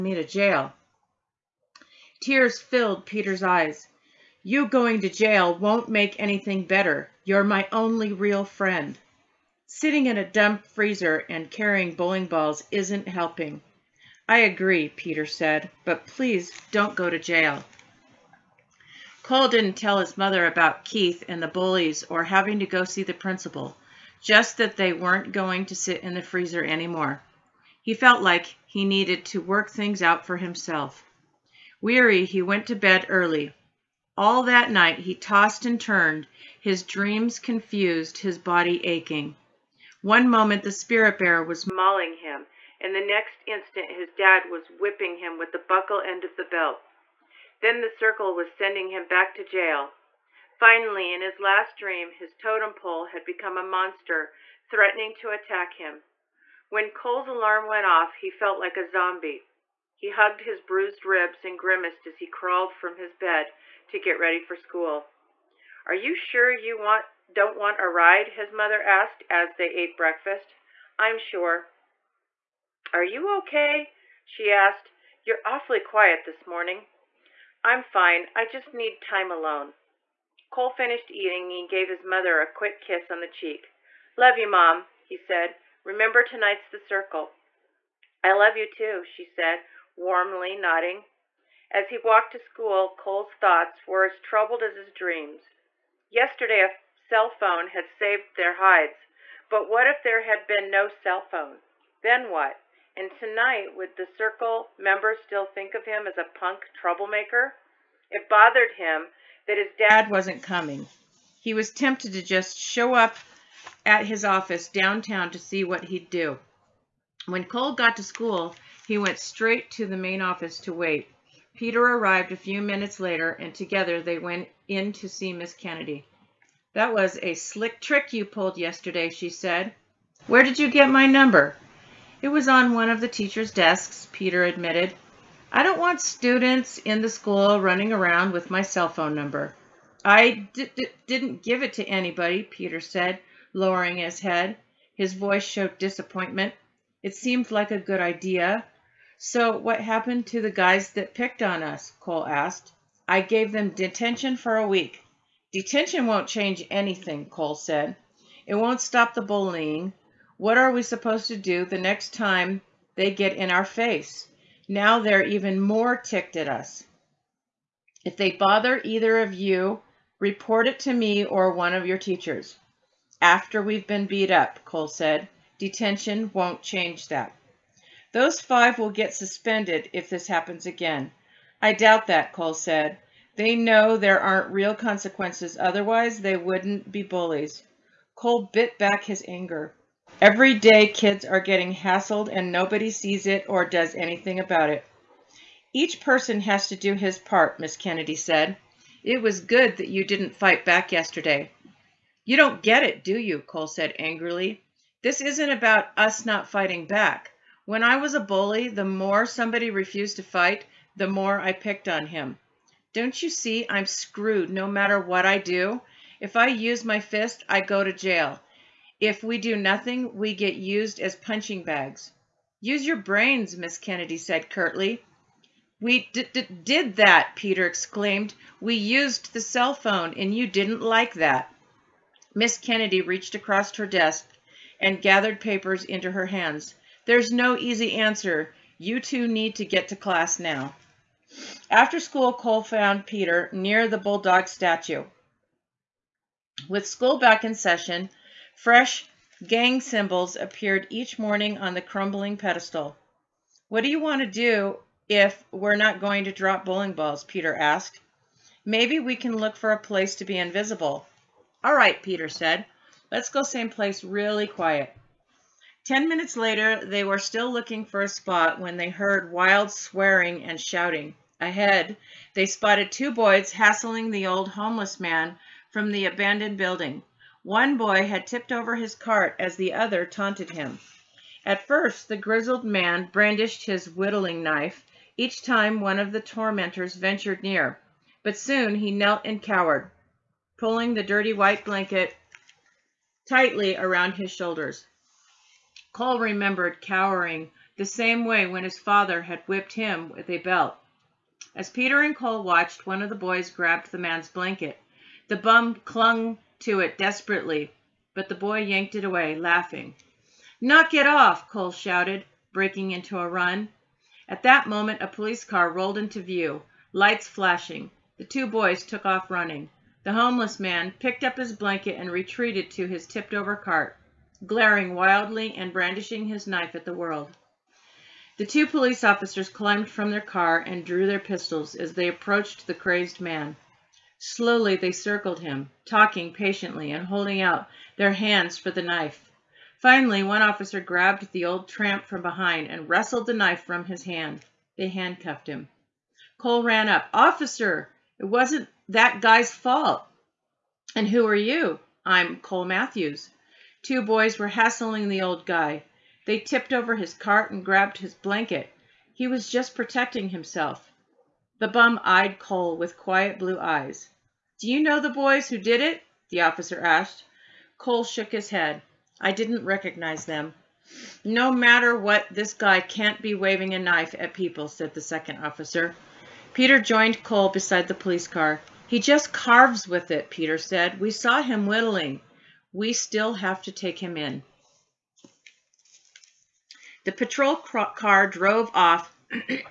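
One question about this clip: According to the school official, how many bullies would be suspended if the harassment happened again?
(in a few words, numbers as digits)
5.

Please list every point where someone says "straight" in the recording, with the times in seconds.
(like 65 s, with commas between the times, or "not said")
119 s.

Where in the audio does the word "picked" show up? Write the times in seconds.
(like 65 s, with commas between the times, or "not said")
151 s, 211 s, 320 s.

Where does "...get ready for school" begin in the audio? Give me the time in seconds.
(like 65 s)
63 s.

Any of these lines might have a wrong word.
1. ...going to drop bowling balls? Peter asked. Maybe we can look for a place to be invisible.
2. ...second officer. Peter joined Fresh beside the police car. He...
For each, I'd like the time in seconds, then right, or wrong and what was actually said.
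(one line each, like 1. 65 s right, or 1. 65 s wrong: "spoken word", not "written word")
1. 255 s right
2. 374 s wrong: "Cole", not "Fresh".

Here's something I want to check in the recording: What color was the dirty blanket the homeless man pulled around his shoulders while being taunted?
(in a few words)
White.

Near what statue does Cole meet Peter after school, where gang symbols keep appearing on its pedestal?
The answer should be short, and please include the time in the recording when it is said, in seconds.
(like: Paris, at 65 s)
Bulldog statue, at 243 s.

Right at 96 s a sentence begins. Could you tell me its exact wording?
Yesterday, a cell phone had saved their hides, but what if there had been no cell phone?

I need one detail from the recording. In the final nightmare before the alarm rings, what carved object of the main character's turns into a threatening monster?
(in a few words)
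Totem pole.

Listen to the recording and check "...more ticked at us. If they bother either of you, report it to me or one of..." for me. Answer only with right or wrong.
right.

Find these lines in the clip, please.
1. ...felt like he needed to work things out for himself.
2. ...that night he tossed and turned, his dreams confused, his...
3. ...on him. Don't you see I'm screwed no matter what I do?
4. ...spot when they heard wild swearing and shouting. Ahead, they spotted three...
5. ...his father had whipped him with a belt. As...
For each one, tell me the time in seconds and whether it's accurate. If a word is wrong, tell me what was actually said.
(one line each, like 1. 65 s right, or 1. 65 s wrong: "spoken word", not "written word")
1. 27 s right
2. 34 s right
3. 211 s right
4. 268 s wrong: "two", not "three"
5. 298 s right.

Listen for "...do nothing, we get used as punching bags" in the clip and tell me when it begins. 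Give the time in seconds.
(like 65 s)
219 s.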